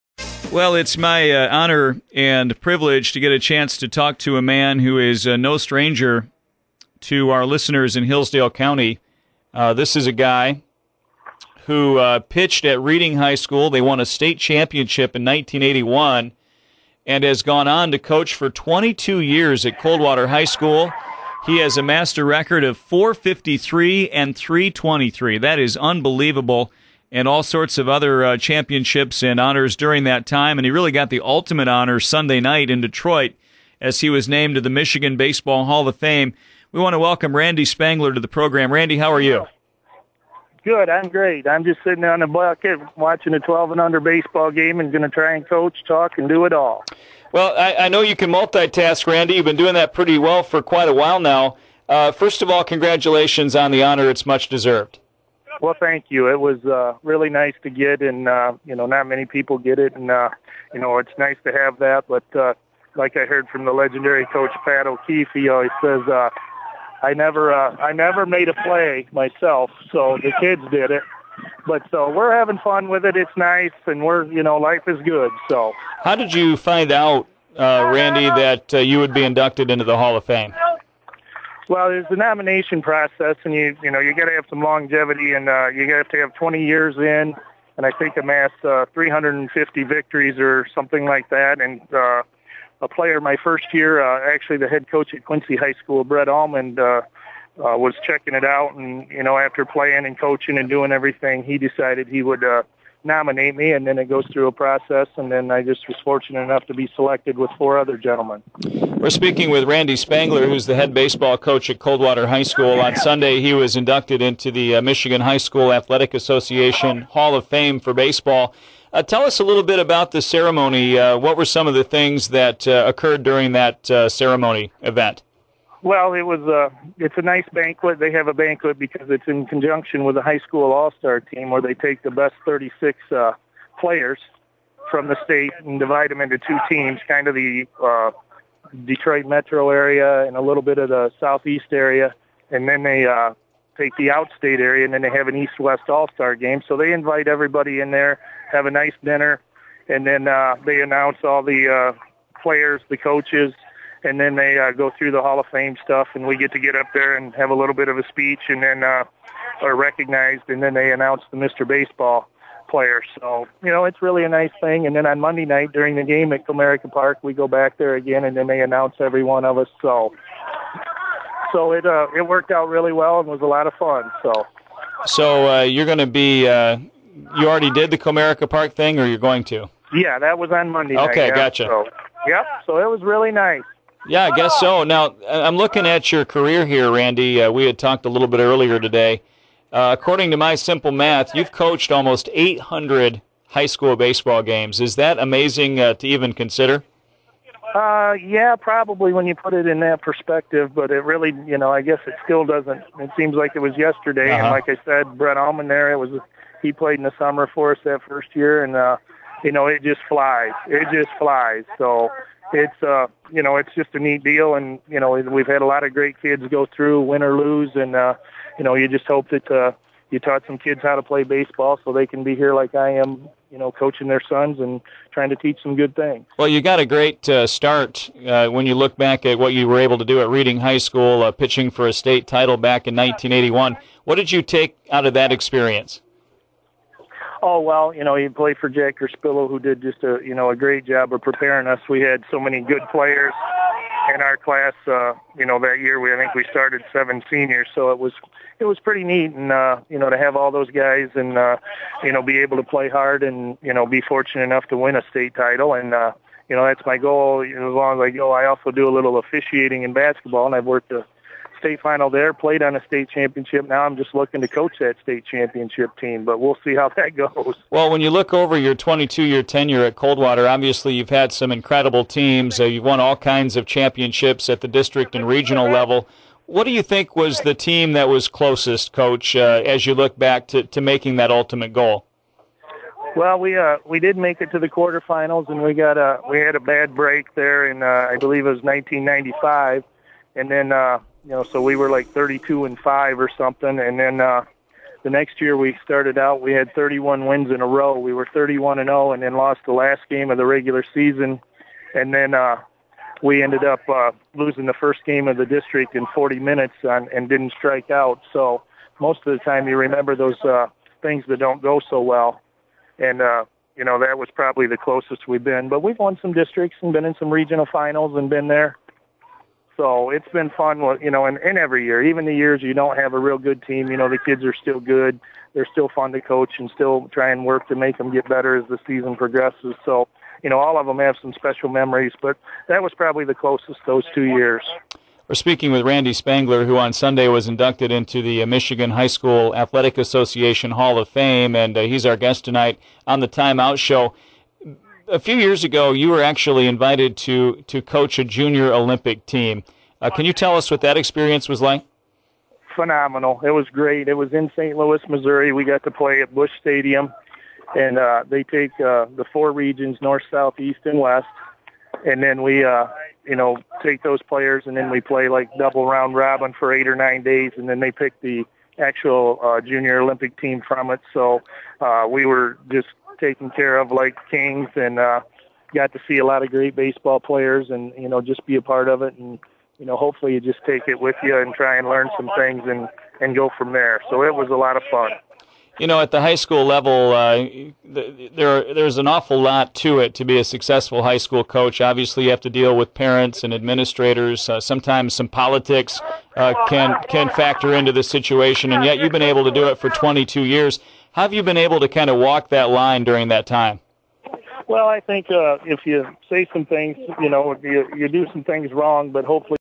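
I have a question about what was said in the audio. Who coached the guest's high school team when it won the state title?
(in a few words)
Jack Spillo.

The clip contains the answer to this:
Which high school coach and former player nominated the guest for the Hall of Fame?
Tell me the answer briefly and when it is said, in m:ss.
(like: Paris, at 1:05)
Brett Almond, at 1:36.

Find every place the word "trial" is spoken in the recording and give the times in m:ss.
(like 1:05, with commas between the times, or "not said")
not said.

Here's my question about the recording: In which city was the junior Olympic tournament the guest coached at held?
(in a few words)
St. Louis.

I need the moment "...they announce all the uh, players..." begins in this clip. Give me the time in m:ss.
2:30.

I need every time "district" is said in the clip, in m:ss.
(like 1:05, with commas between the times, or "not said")
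4:34, 5:05, 5:16.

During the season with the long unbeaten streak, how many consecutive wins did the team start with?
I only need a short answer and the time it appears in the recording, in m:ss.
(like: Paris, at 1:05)
31, at 4:56.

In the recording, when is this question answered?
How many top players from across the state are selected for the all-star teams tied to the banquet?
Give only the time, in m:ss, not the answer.
2:12.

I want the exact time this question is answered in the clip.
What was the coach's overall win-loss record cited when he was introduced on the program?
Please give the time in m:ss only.
0:22.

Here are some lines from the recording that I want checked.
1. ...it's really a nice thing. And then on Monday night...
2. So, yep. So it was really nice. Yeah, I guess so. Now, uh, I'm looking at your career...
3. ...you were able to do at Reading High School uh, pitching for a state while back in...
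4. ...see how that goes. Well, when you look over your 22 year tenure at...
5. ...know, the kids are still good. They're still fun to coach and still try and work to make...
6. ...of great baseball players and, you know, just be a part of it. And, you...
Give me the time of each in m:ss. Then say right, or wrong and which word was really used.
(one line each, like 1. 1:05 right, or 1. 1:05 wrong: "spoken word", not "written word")
1. 2:43 right
2. 3:01 right
3. 3:49 wrong: "title", not "while"
4. 4:26 right
5. 5:23 right
6. 6:16 right.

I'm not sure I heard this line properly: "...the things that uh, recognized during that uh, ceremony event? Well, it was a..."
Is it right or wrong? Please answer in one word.
wrong.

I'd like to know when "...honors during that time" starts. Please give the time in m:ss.
0:29.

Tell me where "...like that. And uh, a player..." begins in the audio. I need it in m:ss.
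1:31.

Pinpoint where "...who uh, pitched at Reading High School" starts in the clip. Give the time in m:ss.
0:11.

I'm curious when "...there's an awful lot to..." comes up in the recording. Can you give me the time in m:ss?
6:28.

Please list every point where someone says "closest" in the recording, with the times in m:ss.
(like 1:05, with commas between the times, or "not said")
4:38, 5:14, 5:33.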